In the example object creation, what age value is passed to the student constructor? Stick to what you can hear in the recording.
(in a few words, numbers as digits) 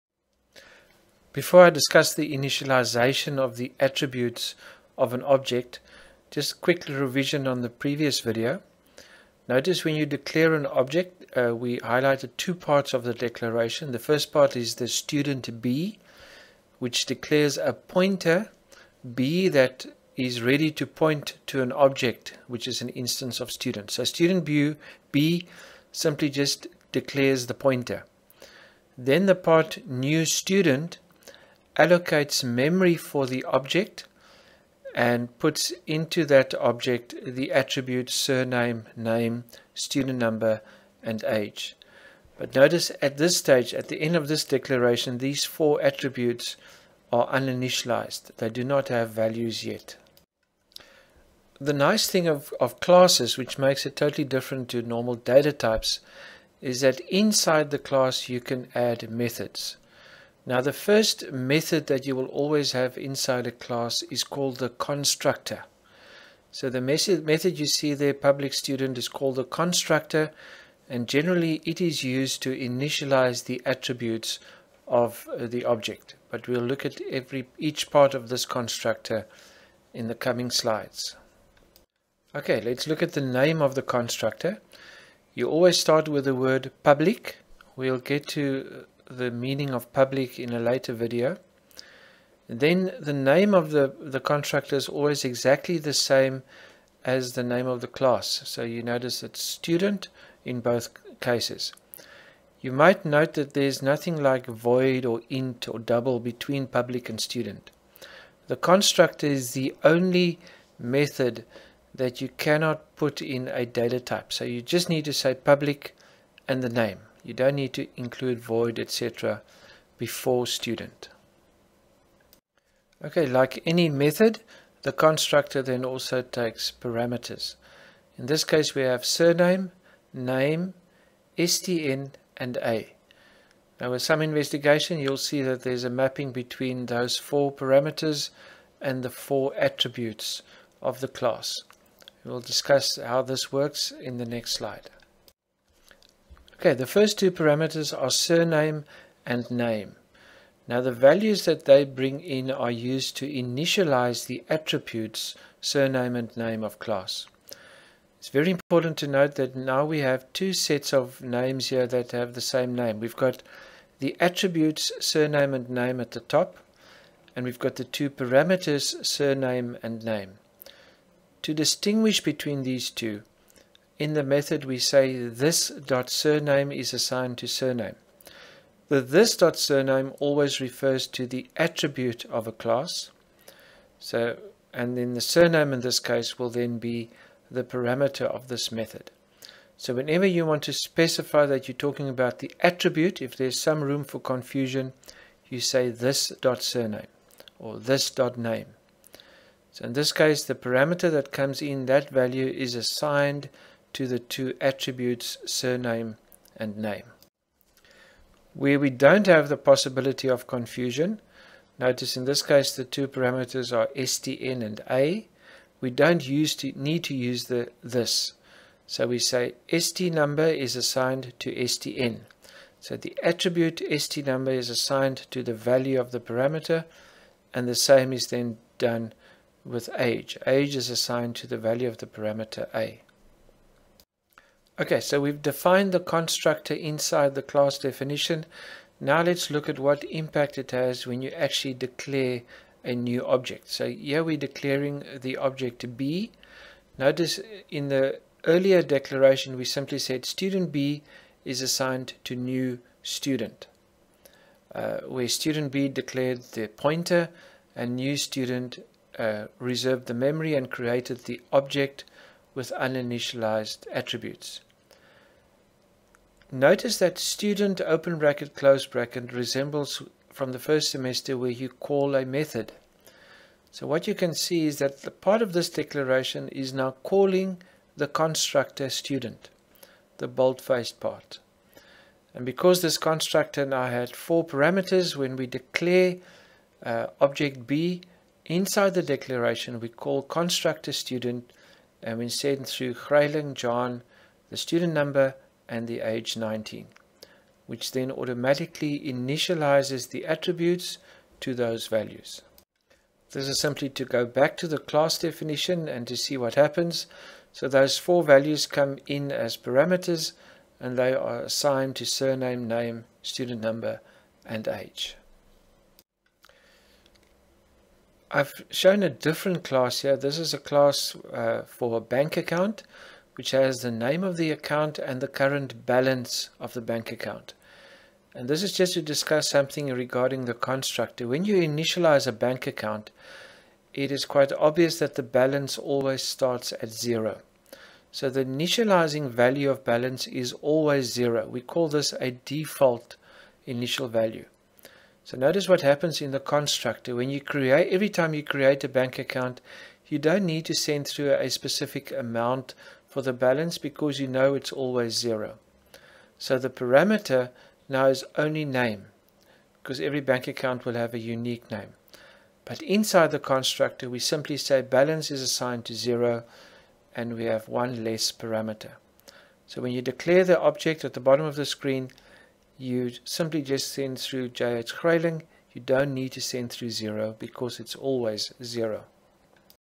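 19.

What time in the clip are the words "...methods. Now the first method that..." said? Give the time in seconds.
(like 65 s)
59 s.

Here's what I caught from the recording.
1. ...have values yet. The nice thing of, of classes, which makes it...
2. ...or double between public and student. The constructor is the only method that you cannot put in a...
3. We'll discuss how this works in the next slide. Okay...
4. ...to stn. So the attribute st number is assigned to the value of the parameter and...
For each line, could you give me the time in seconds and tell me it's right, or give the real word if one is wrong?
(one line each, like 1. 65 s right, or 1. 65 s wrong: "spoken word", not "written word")
1. 48 s right
2. 105 s right
3. 142 s right
4. 221 s right.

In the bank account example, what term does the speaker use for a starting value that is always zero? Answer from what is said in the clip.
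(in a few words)
Default initial value.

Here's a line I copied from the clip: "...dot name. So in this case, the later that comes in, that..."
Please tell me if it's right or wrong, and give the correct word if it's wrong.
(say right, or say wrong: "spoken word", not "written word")
wrong: "parameter", not "later".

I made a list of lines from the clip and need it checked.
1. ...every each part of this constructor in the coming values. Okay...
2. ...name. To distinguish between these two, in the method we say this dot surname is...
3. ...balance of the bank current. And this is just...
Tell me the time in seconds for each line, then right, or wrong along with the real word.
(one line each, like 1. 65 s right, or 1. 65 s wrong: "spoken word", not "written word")
1. 77 s wrong: "slides", not "values"
2. 170 s right
3. 325 s wrong: "account", not "current".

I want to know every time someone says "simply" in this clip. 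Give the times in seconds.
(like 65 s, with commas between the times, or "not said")
25 s, 249 s, 303 s, 364 s, 373 s.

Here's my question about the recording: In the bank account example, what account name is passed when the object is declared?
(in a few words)
JH Grayling.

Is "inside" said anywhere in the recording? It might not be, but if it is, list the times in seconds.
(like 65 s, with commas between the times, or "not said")
57 s, 62 s, 236 s, 288 s, 362 s.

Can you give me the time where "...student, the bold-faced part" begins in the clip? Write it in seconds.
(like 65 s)
278 s.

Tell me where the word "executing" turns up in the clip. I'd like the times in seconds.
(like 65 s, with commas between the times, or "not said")
not said.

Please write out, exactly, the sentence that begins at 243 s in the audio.
So here we're declaring the object B.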